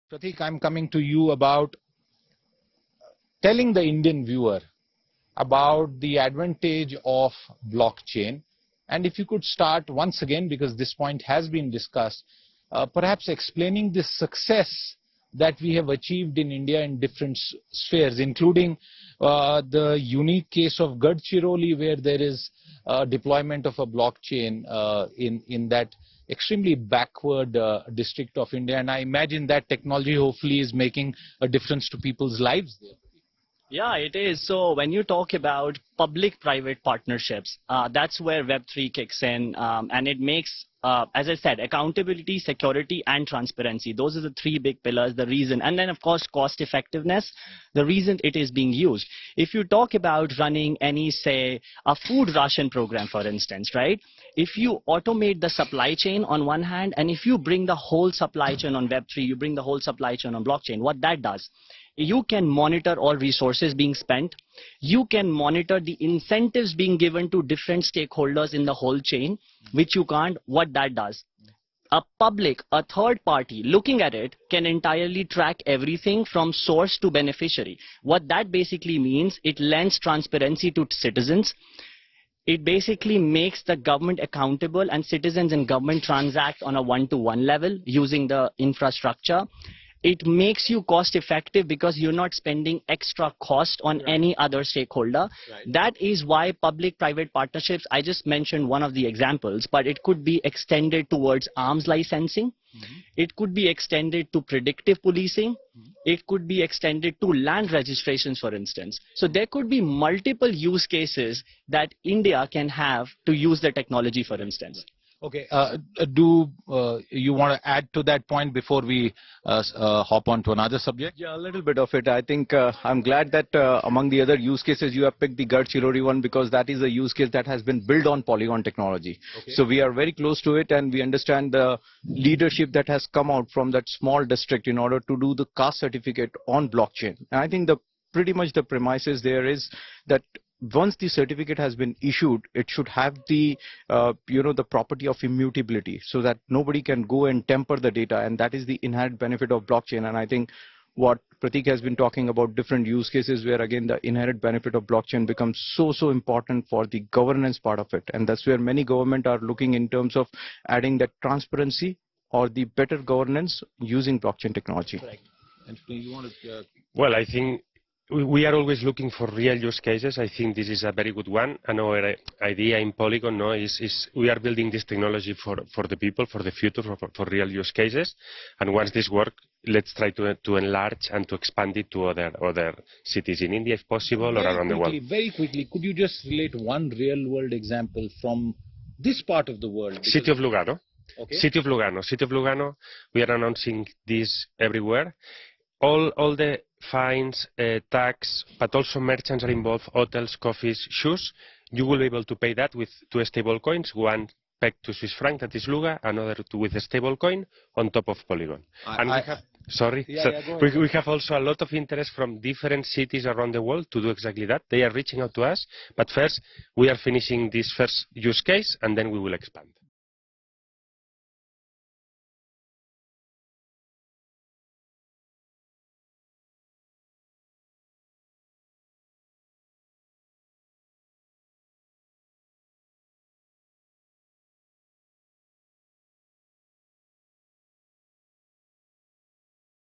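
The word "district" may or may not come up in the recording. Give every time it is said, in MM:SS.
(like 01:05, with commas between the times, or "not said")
00:27, 02:14.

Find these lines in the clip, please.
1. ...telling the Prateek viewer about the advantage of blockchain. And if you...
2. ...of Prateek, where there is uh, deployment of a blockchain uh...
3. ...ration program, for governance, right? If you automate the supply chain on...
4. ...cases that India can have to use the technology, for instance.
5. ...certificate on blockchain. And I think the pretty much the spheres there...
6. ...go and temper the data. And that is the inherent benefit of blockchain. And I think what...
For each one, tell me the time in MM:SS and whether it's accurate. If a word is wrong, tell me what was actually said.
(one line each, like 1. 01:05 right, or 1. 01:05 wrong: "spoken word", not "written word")
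1. 00:03 wrong: "Indian", not "Prateek"
2. 00:20 wrong: "Gadchiroli", not "Prateek"
3. 00:52 wrong: "instance", not "governance"
4. 01:50 right
5. 02:15 wrong: "premises", not "spheres"
6. 02:27 right.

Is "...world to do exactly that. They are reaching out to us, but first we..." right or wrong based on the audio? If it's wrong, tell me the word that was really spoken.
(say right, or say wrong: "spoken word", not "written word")
right.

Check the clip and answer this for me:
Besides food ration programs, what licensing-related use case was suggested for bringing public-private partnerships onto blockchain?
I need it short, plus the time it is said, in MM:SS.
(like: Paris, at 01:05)
Arms licensing, at 01:41.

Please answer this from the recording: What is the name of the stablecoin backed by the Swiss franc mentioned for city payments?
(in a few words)
Luga.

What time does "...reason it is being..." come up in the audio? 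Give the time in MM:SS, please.
00:47.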